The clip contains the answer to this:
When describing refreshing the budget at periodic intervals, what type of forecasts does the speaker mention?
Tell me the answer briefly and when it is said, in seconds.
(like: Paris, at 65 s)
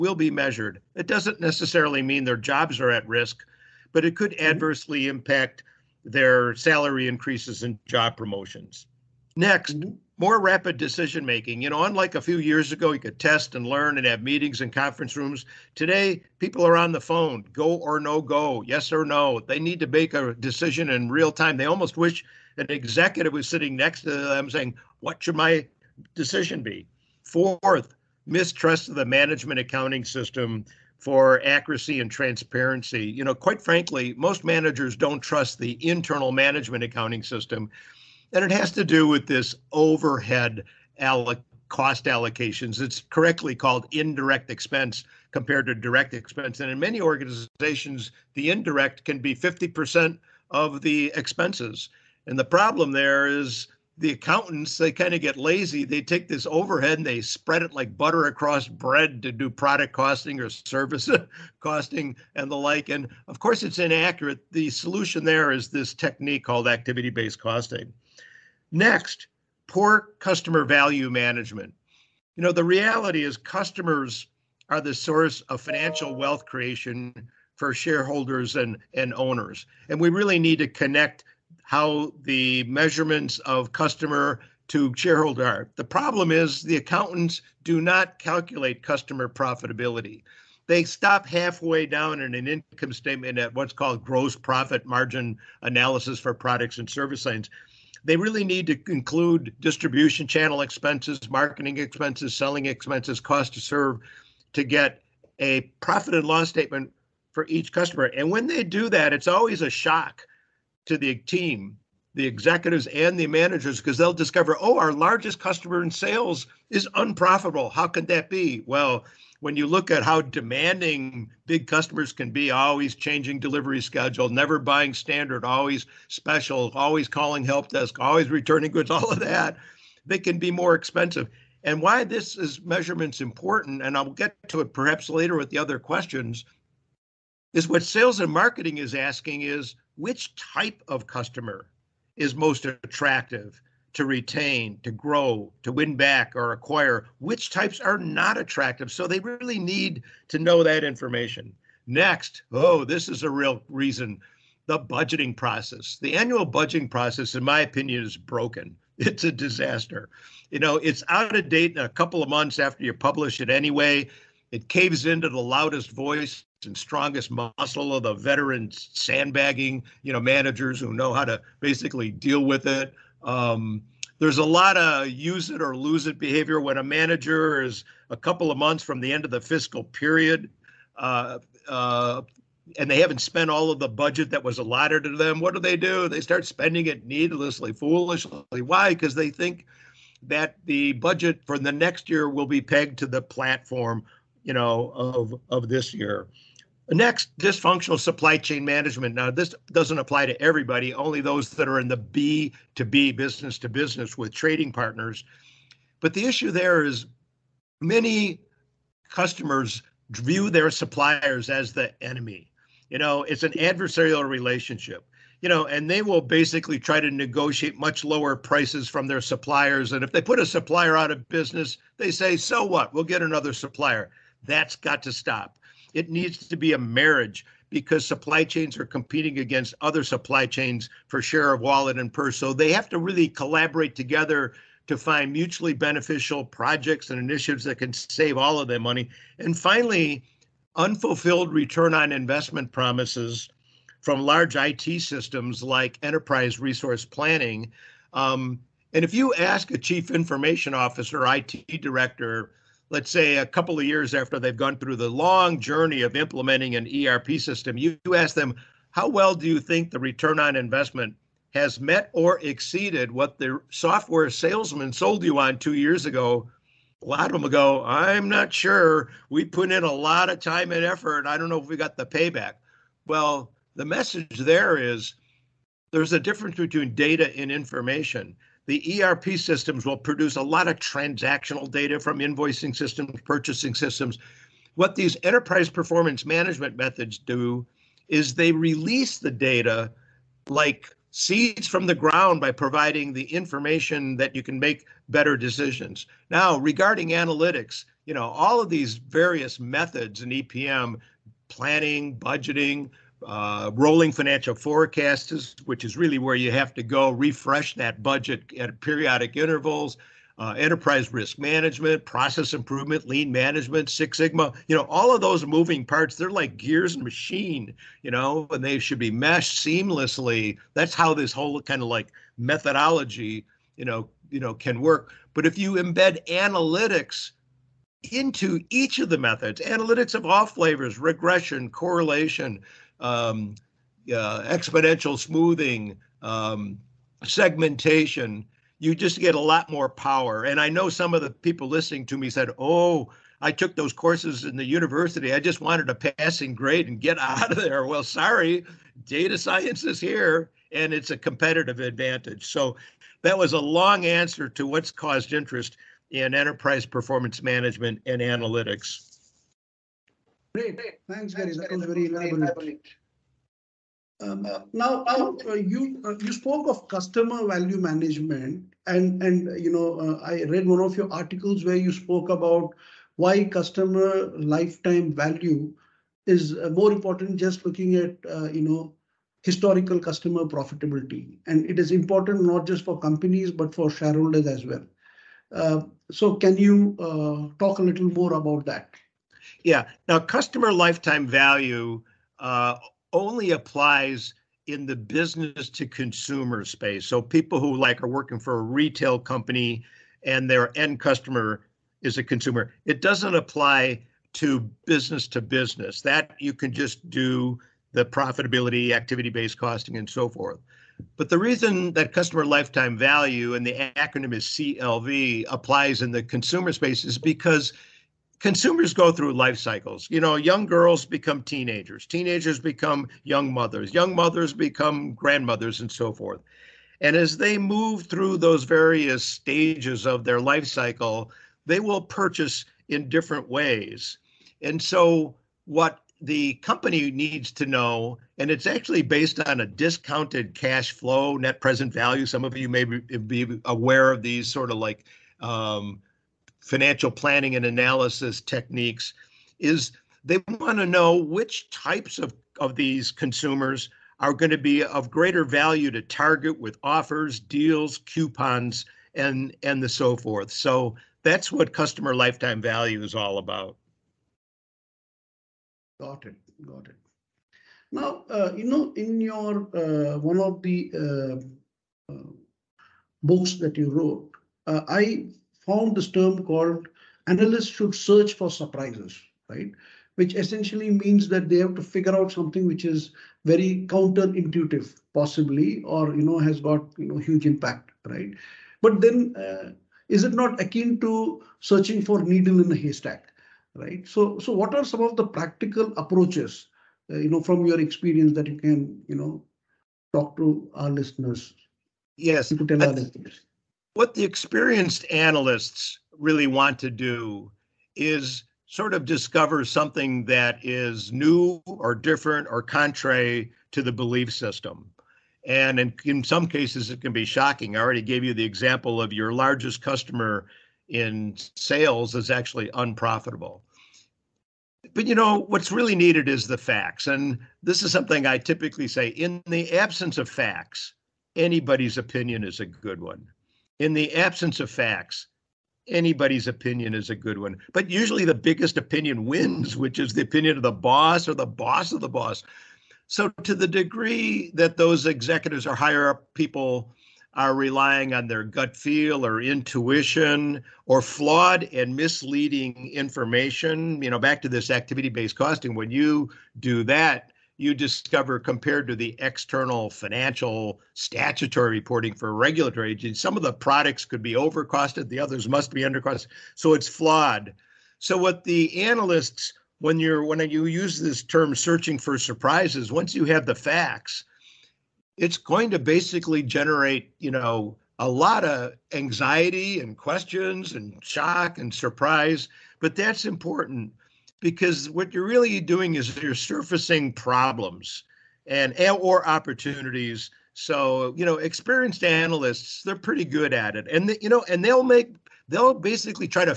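rolling financial forecasts, at 303 s.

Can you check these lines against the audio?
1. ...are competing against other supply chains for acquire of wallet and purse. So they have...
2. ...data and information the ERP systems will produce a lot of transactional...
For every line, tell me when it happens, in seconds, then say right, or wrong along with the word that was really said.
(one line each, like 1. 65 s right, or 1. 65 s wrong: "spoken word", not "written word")
1. 228 s wrong: "share", not "acquire"
2. 276 s right.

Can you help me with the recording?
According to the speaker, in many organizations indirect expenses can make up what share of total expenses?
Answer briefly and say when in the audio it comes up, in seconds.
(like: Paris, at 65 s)
50%, at 49 s.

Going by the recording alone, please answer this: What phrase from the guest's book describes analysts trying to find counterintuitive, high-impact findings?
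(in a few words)
search for surprises.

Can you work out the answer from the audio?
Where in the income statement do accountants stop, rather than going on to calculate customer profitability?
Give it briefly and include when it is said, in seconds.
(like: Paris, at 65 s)
gross profit margin, at 94 s.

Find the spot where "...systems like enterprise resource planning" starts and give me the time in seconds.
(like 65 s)
245 s.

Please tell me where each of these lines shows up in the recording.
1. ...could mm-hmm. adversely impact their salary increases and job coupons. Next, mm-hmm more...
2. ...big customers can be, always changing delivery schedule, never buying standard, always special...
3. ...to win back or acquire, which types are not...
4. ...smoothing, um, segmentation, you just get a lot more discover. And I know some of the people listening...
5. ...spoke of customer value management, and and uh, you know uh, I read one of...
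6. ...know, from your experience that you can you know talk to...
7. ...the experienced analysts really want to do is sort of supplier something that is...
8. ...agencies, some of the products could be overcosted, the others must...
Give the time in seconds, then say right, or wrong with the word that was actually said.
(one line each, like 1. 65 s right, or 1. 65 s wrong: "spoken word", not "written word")
1. 4 s wrong: "promotions", not "coupons"
2. 121 s right
3. 145 s right
4. 335 s wrong: "power", not "discover"
5. 366 s right
6. 497 s right
7. 504 s wrong: "discover", not "supplier"
8. 562 s right.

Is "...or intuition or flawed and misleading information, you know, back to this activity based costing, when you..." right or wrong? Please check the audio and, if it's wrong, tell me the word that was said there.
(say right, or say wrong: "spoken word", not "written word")
right.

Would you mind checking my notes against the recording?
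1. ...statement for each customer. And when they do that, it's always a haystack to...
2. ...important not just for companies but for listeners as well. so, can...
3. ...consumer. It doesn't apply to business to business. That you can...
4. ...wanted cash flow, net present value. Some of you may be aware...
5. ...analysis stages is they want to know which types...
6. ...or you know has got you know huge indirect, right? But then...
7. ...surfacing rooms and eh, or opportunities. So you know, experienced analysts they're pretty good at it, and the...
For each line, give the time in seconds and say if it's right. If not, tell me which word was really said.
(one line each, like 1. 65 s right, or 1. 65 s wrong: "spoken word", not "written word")
1. 106 s wrong: "shock", not "haystack"
2. 381 s wrong: "shareholders", not "listeners"
3. 402 s right
4. 439 s wrong: "discounted", not "wanted"
5. 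447 s wrong: "techniques", not "stages"
6. 485 s wrong: "impact", not "indirect"
7. 586 s wrong: "problems", not "rooms".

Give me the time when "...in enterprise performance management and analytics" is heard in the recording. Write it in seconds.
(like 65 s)
356 s.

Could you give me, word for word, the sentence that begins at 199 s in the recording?
Now, this doesn't apply to everybody, only those that are in the B to B, business to business with trading partners.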